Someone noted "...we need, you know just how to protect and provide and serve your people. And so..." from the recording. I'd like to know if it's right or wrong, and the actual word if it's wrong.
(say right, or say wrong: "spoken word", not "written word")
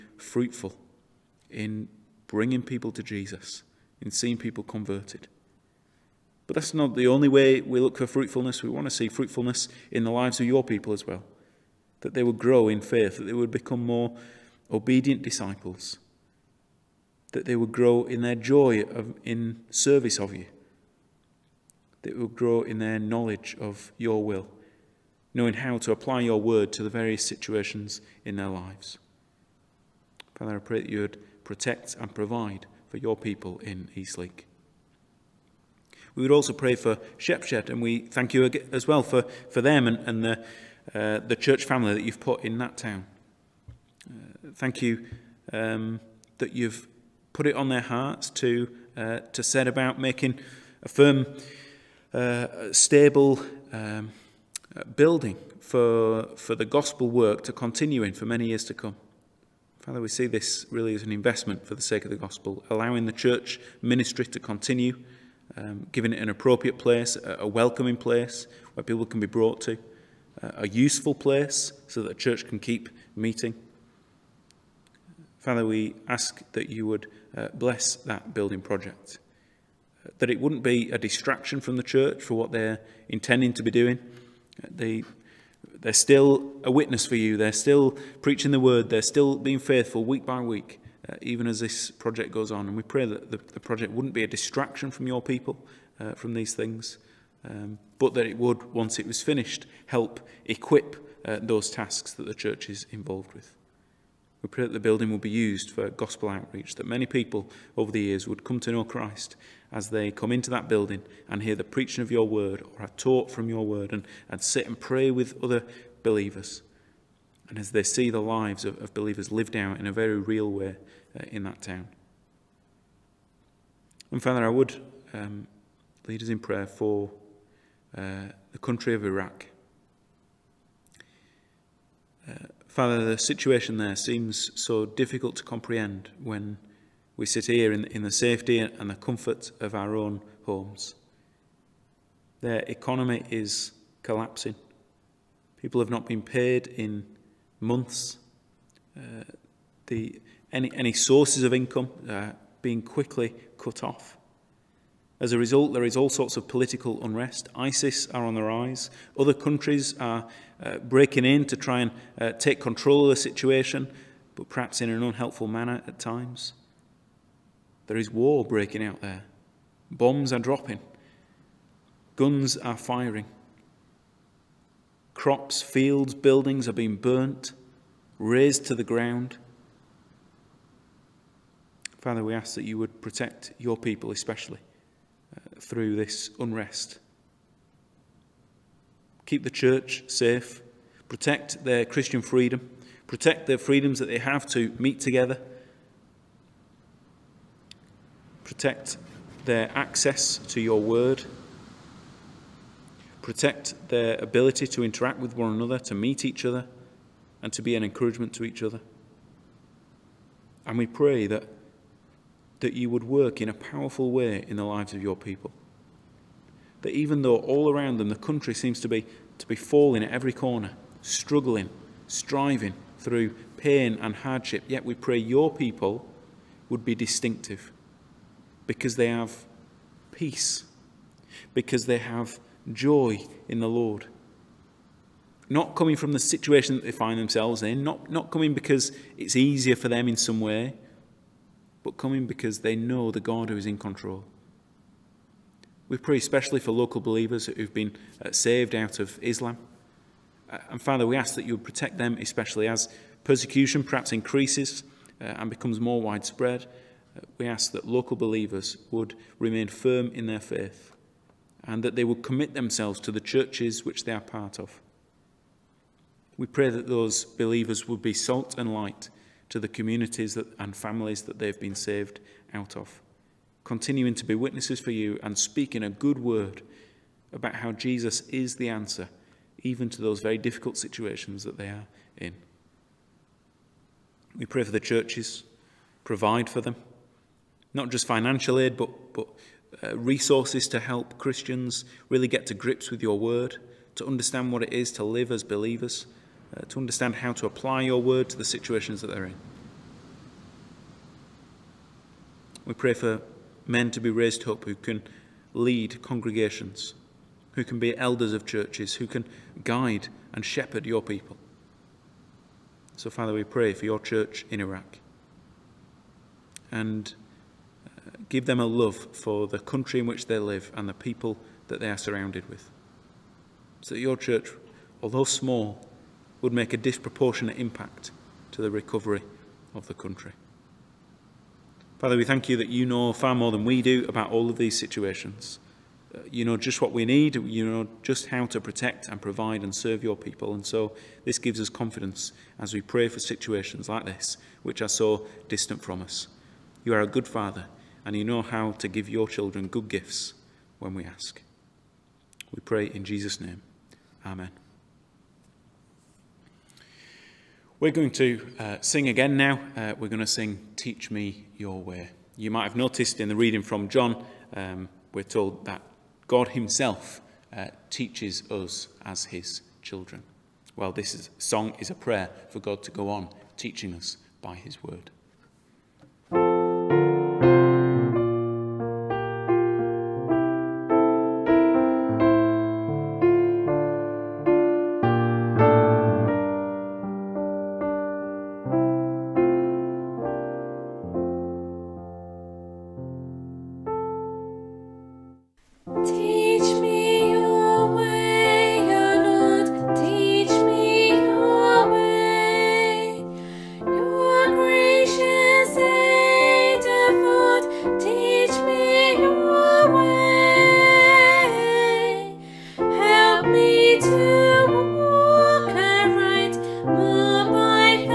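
right.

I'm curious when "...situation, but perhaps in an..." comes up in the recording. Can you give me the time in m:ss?
2:43.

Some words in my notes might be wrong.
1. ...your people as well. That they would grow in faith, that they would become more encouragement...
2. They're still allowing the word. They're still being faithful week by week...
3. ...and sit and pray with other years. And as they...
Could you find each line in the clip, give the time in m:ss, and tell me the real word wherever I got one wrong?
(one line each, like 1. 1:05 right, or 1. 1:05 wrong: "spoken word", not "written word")
1. 0:10 wrong: "obedient", not "encouragement"
2. 1:27 wrong: "preaching", not "allowing"
3. 1:54 wrong: "believers", not "years".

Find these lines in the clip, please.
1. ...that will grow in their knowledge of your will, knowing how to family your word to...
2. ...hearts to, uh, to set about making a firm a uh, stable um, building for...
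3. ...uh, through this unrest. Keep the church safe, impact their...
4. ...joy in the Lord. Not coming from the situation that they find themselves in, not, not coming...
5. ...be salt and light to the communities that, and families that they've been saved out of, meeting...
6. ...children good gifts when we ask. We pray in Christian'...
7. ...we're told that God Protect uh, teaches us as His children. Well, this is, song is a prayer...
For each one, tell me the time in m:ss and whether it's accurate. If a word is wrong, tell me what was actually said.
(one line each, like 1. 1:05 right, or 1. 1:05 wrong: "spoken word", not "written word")
1. 0:22 wrong: "apply", not "family"
2. 0:47 right
3. 3:05 wrong: "protect", not "impact"
4. 3:52 right
5. 4:28 wrong: "continuing", not "meeting"
6. 5:49 wrong: "Jesus", not "Christian"
7. 6:05 wrong: "Himself", not "Protect".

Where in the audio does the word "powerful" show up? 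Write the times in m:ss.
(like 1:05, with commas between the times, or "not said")
3:33.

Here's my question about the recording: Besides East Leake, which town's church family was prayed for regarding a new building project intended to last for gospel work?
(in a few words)
Shepshed.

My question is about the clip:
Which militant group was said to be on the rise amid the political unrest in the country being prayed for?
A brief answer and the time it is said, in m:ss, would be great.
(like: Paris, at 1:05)
ISIS, at 2:37.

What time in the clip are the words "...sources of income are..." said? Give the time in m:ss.
2:30.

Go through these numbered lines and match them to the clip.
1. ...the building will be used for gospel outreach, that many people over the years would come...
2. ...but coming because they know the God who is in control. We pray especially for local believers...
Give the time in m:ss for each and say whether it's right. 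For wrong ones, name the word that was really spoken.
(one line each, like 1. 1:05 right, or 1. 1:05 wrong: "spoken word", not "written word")
1. 1:44 right
2. 4:01 right.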